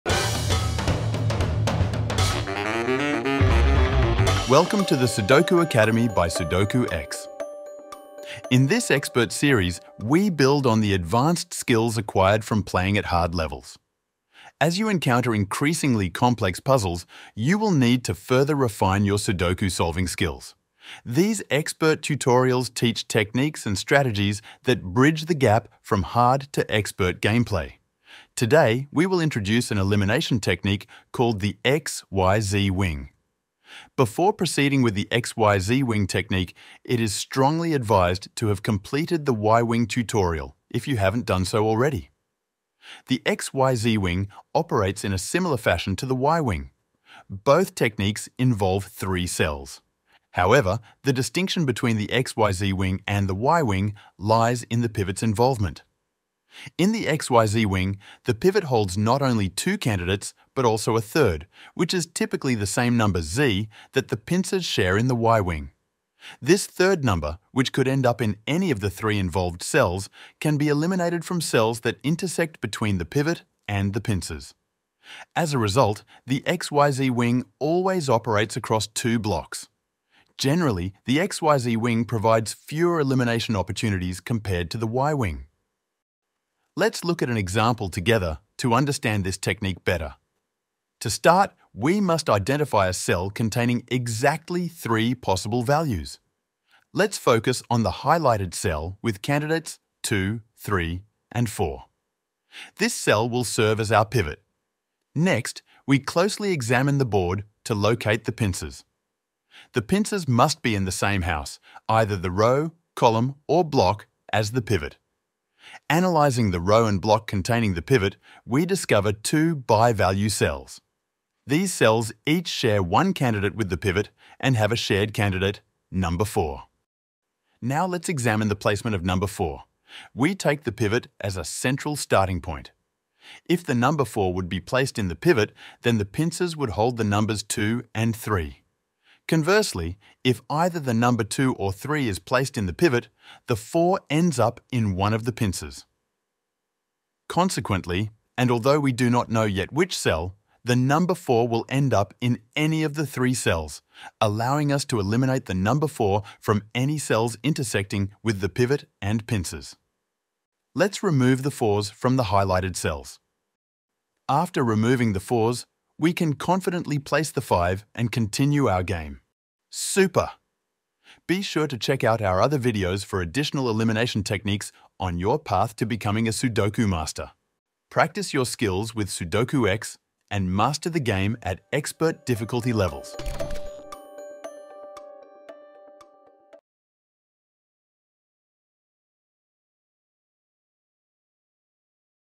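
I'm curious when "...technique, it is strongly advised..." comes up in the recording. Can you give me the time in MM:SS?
00:36.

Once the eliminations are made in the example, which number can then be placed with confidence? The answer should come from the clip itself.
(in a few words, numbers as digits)
5.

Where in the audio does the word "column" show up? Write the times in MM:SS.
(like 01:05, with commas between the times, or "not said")
01:52.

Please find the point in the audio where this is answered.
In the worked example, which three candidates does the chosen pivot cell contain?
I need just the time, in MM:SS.
01:40.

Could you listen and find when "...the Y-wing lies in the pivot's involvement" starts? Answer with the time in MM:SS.
00:53.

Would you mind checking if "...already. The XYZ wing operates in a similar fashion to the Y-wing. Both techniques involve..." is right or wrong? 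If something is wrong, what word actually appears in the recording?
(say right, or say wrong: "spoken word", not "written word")
right.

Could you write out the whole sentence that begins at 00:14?
As you encounter increasingly complex puzzles, you will need to further refine your Sudoku solving skills.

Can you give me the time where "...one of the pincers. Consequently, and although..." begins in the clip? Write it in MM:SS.
02:24.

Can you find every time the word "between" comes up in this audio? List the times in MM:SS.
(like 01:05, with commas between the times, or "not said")
00:51, 01:12.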